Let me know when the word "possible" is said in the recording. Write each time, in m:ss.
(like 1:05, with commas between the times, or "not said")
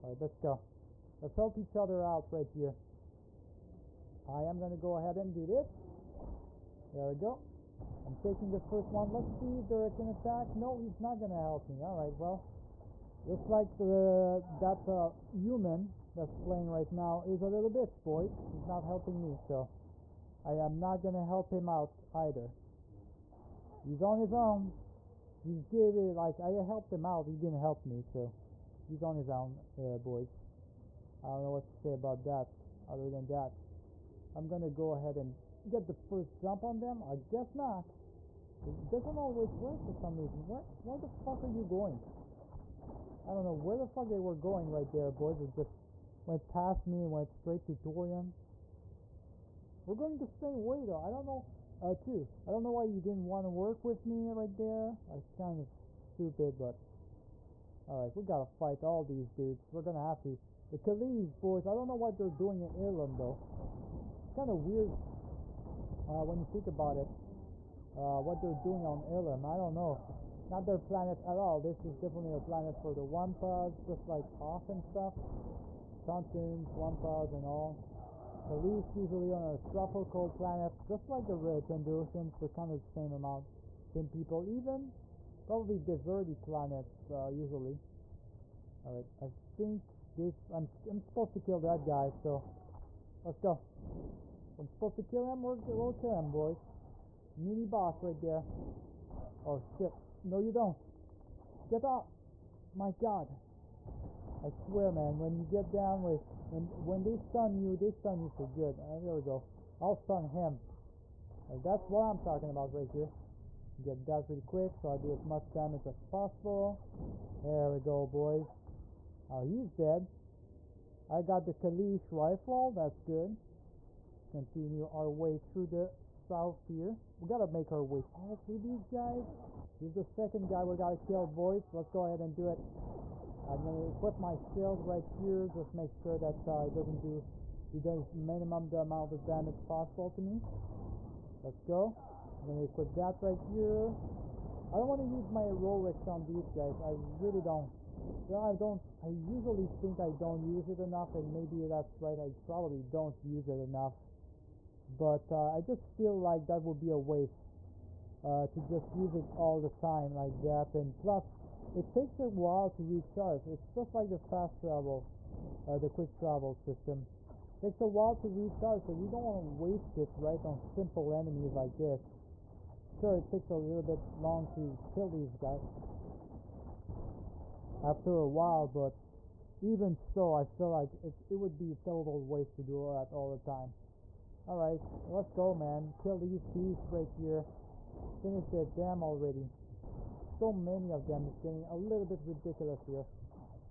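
1:56, 2:19.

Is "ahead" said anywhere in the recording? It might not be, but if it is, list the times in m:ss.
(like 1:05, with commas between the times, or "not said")
0:04, 0:34, 2:12.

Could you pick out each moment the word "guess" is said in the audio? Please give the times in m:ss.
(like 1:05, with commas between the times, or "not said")
0:37.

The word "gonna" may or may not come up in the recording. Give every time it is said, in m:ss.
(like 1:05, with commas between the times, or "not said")
0:34, 0:59, 2:13, 2:22.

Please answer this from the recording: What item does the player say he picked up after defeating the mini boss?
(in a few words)
Kaleesh rifle.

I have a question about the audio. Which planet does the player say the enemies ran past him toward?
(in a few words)
Torian.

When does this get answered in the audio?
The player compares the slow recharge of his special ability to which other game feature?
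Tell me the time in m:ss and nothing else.
2:45.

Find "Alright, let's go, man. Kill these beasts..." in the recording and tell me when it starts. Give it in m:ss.
3:04.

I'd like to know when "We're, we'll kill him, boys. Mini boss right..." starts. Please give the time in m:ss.
1:35.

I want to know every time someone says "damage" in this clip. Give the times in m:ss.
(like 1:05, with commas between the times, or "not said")
1:55, 2:19.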